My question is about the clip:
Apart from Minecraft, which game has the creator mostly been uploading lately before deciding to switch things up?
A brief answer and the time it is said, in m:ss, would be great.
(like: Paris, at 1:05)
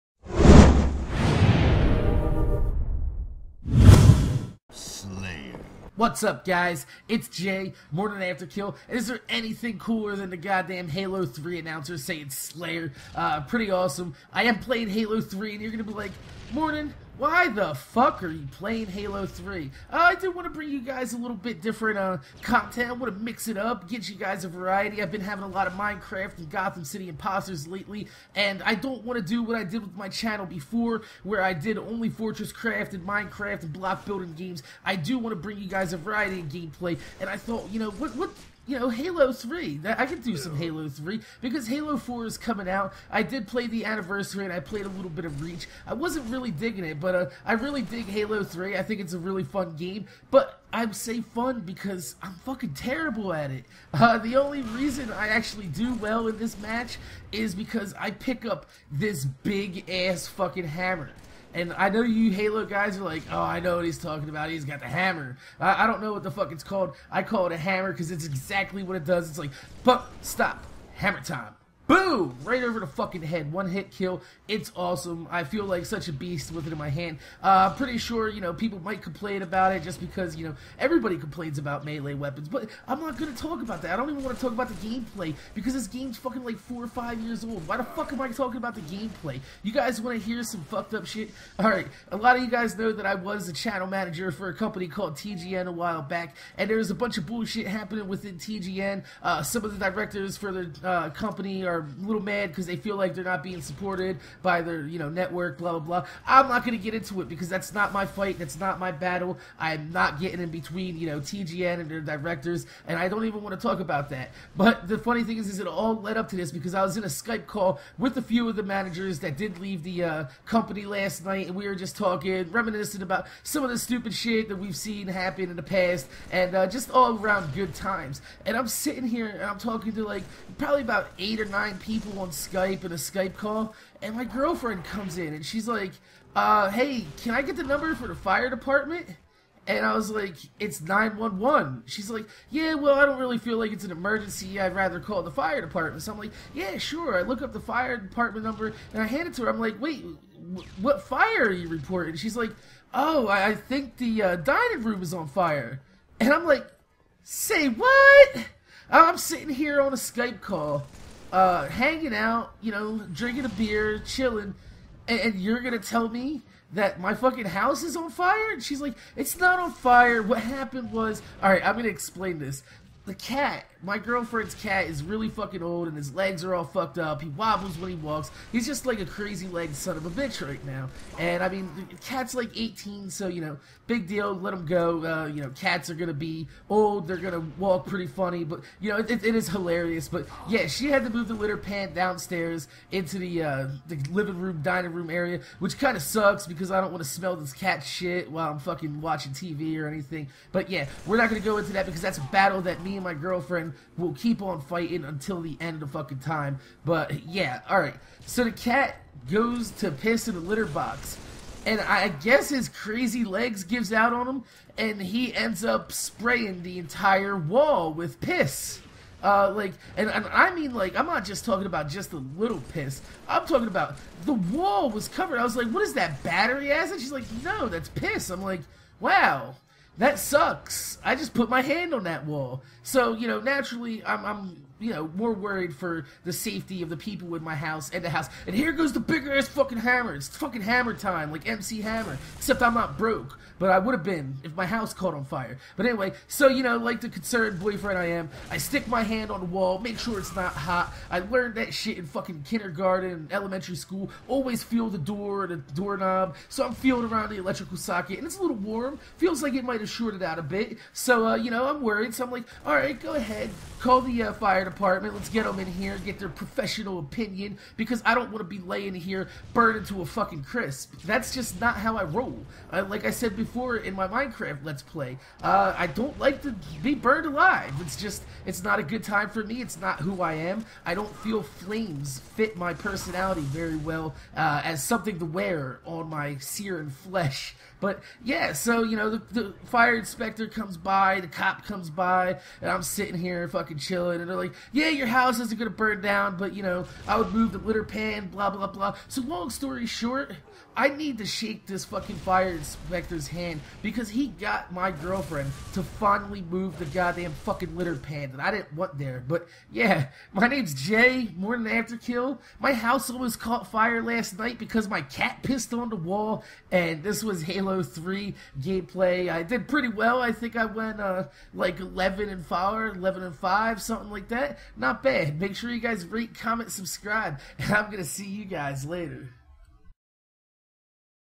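Gotham City Imposters, at 0:26.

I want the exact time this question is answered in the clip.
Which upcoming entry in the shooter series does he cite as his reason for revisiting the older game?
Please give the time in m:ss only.
0:41.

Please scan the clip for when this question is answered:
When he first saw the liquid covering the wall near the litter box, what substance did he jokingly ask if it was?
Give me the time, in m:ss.
3:46.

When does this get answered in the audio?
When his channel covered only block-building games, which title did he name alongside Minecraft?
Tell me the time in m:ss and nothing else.
0:32.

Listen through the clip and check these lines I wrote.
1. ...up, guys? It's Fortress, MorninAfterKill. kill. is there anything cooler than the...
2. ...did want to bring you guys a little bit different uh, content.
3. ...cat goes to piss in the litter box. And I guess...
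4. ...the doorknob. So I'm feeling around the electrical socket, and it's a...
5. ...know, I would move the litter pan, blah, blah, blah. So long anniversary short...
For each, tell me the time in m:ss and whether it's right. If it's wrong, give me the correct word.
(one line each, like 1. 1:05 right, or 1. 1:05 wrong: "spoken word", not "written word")
1. 0:06 wrong: "Jay", not "Fortress"
2. 0:20 right
3. 3:28 right
4. 4:15 right
5. 4:56 wrong: "story", not "anniversary".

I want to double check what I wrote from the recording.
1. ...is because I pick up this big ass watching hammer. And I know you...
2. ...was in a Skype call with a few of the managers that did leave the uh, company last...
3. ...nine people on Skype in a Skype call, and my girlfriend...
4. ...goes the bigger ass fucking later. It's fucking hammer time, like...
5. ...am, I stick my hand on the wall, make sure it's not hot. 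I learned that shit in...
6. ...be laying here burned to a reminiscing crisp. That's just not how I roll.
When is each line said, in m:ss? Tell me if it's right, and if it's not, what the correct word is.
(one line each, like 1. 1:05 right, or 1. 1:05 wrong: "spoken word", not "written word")
1. 0:57 wrong: "fucking", not "watching"
2. 1:56 right
3. 2:11 right
4. 3:58 wrong: "hammer", not "later"
5. 4:08 right
6. 4:28 wrong: "fucking", not "reminiscing".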